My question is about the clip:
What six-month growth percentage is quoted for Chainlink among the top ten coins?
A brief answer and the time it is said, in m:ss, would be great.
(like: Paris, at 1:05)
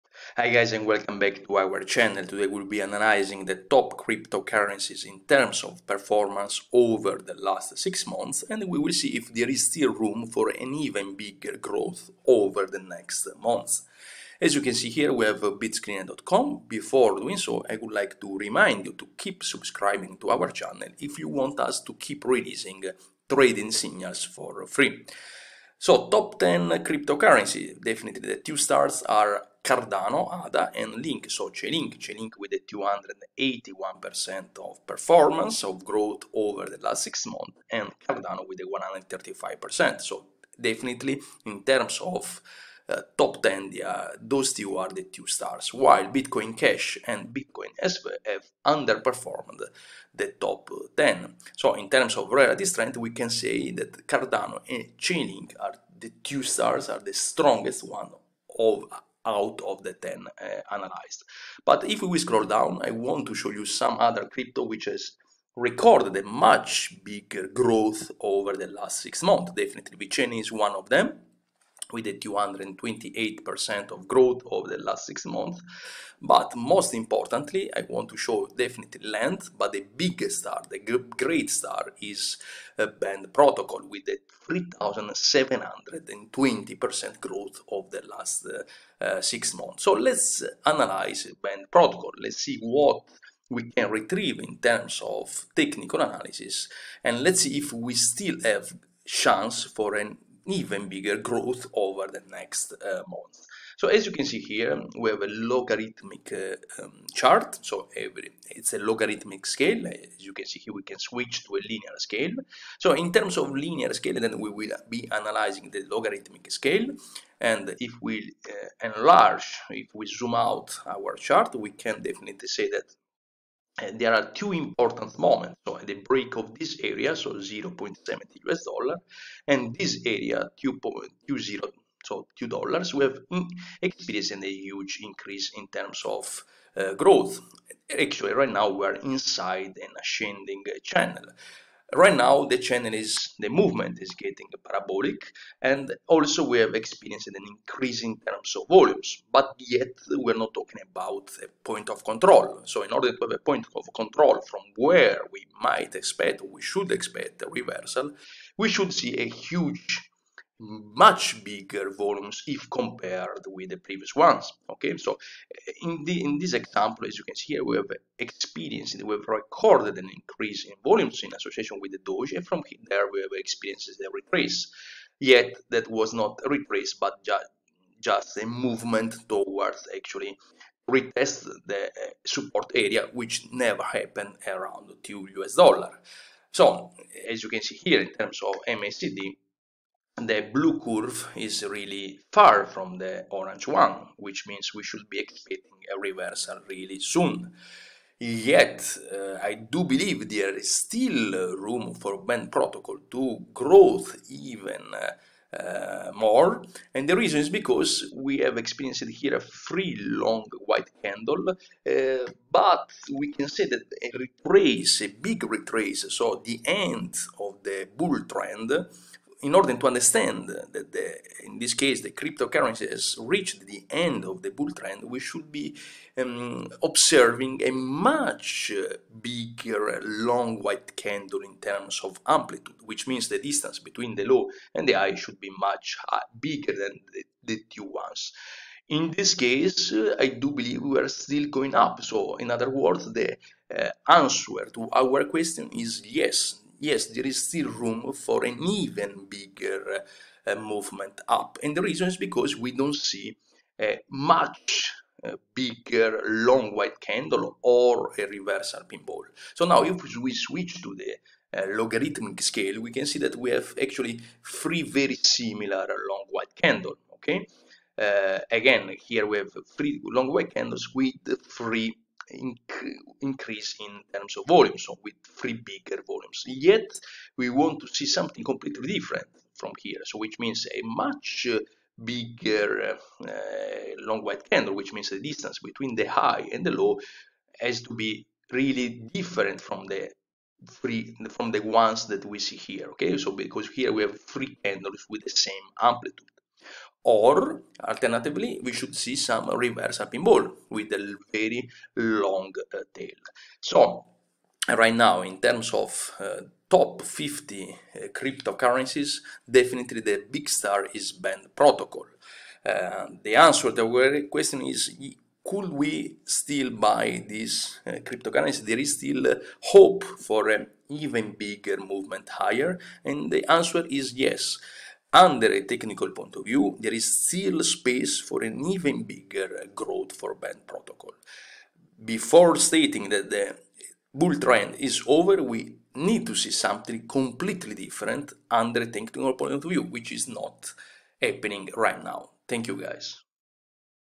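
281%, at 0:32.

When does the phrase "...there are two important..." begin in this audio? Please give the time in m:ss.
2:03.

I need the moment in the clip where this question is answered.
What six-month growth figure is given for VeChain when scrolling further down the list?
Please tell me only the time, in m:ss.
1:12.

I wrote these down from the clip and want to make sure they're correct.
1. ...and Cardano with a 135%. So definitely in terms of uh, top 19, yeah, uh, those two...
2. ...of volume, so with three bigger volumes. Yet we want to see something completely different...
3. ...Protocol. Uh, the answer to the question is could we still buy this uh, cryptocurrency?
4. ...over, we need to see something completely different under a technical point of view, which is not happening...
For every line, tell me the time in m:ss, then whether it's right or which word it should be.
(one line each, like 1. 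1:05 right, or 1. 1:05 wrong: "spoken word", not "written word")
1. 0:37 wrong: "10", not "19"
2. 4:34 right
3. 5:11 right
4. 5:35 right.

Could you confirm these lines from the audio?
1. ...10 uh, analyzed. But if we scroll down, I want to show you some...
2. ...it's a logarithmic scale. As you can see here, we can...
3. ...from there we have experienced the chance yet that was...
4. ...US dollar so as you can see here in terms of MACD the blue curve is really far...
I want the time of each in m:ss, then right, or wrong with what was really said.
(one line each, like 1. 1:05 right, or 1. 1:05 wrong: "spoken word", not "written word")
1. 0:59 right
2. 1:48 right
3. 2:52 wrong: "retrace", not "chance"
4. 3:05 right.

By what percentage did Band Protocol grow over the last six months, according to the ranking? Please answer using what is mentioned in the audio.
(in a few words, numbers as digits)
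3,720%.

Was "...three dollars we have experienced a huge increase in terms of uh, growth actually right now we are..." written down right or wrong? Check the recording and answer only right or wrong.
wrong.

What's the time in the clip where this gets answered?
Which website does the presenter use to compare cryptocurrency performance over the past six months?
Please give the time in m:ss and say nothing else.
0:15.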